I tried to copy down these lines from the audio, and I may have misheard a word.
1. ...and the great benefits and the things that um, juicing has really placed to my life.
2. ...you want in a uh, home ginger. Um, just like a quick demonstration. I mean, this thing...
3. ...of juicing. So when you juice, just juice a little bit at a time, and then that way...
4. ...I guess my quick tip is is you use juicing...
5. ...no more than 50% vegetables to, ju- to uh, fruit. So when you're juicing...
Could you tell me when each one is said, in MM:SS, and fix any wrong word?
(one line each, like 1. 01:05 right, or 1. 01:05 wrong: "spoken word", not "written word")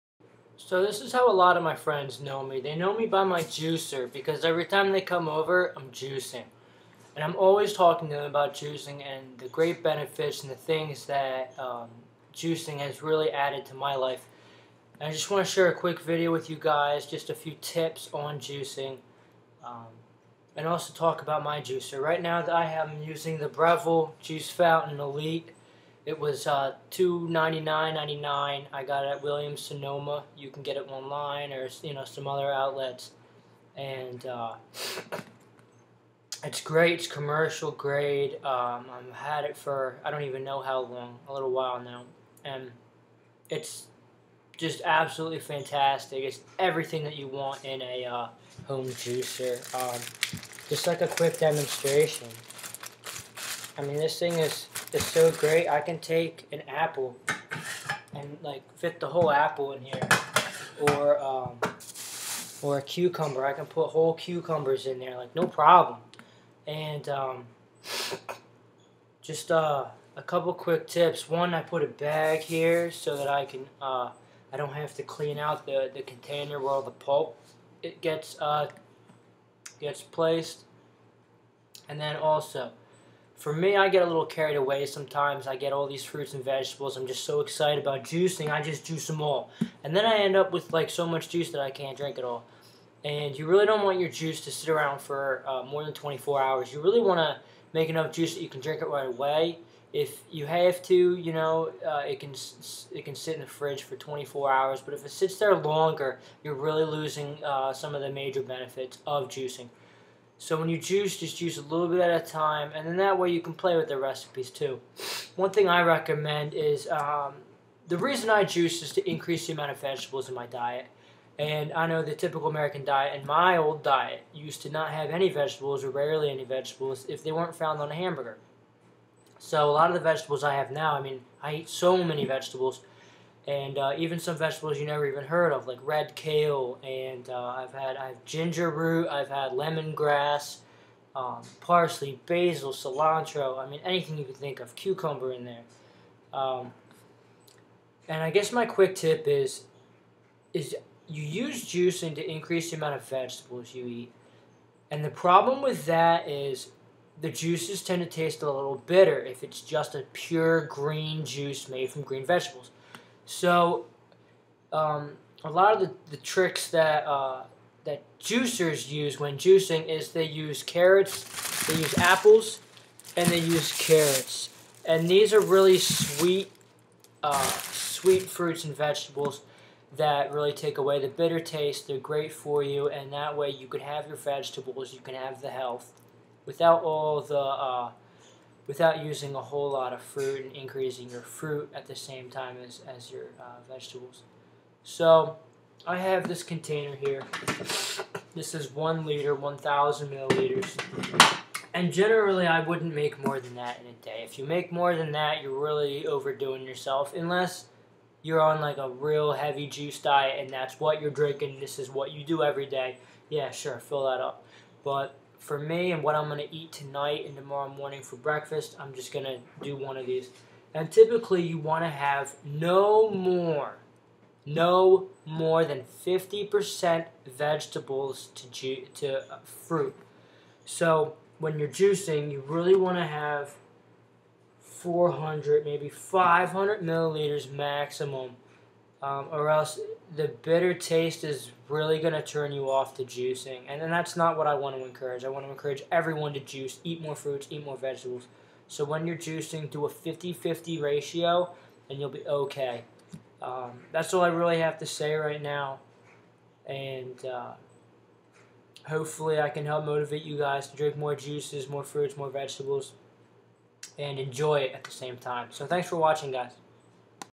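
1. 00:09 wrong: "added", not "placed"
2. 00:47 wrong: "juicer", not "ginger"
3. 01:49 right
4. 02:28 right
5. 03:44 right.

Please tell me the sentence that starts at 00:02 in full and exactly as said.
They know me by my juicer because every time they come over, I'm juicing.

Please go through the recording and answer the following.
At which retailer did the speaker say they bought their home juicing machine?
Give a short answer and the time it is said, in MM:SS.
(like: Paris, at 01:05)
Williams Sonoma, at 00:29.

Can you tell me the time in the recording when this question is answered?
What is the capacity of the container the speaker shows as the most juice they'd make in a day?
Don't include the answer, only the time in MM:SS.
03:18.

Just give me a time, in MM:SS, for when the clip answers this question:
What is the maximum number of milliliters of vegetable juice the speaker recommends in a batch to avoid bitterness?
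03:55.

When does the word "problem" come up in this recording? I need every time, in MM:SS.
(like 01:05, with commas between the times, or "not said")
01:05, 02:35.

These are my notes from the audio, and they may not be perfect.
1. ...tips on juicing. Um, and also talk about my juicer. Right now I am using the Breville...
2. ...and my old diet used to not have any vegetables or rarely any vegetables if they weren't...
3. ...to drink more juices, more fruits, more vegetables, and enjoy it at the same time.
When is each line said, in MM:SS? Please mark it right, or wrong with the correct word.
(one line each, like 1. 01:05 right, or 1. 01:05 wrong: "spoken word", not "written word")
1. 00:17 right
2. 02:03 right
3. 04:20 right.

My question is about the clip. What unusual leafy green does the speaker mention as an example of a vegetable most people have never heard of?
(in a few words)
red kale.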